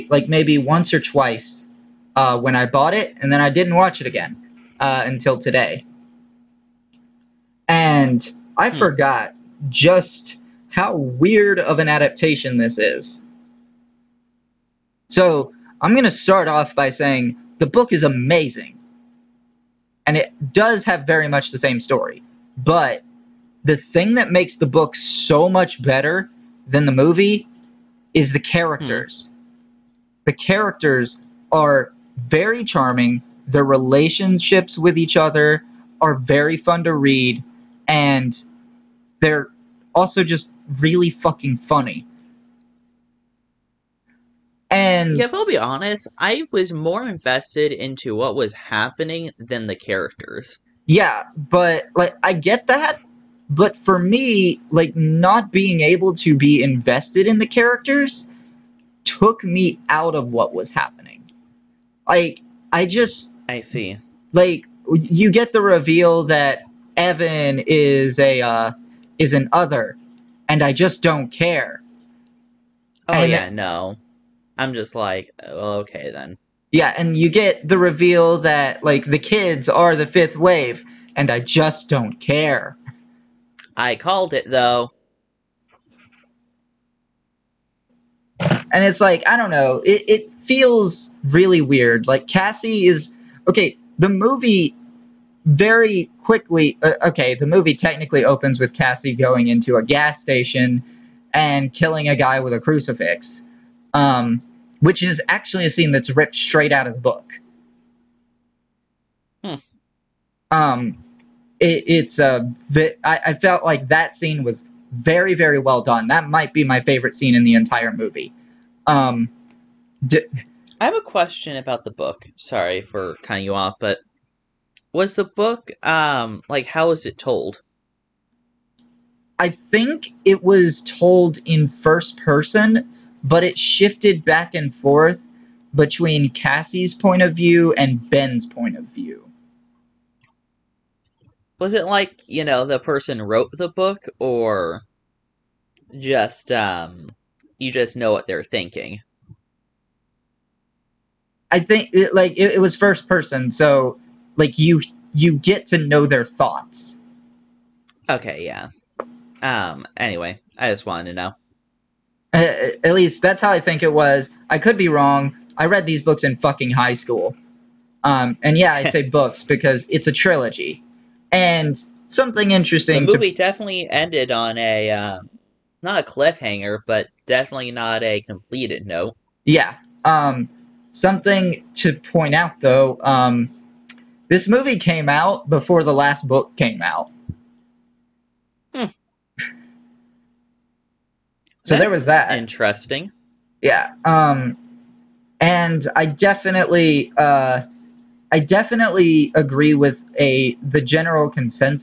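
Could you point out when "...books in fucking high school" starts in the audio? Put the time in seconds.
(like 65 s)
166 s.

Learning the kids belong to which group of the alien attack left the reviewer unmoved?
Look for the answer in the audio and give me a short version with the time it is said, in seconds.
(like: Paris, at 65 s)
The fifth wave, at 79 s.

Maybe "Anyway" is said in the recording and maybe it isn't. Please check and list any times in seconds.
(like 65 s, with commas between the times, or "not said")
159 s.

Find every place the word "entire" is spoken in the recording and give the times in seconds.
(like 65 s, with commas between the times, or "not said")
117 s.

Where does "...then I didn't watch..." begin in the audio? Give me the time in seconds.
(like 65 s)
3 s.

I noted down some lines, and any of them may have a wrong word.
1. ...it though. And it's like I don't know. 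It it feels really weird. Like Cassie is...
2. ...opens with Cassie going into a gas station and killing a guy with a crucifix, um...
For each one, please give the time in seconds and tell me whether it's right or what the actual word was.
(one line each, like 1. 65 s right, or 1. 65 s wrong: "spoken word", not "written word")
1. 84 s right
2. 98 s right.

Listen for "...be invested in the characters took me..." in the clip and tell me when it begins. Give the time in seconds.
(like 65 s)
56 s.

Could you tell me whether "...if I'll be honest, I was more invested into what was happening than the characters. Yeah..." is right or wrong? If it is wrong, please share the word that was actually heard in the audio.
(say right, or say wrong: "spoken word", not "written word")
right.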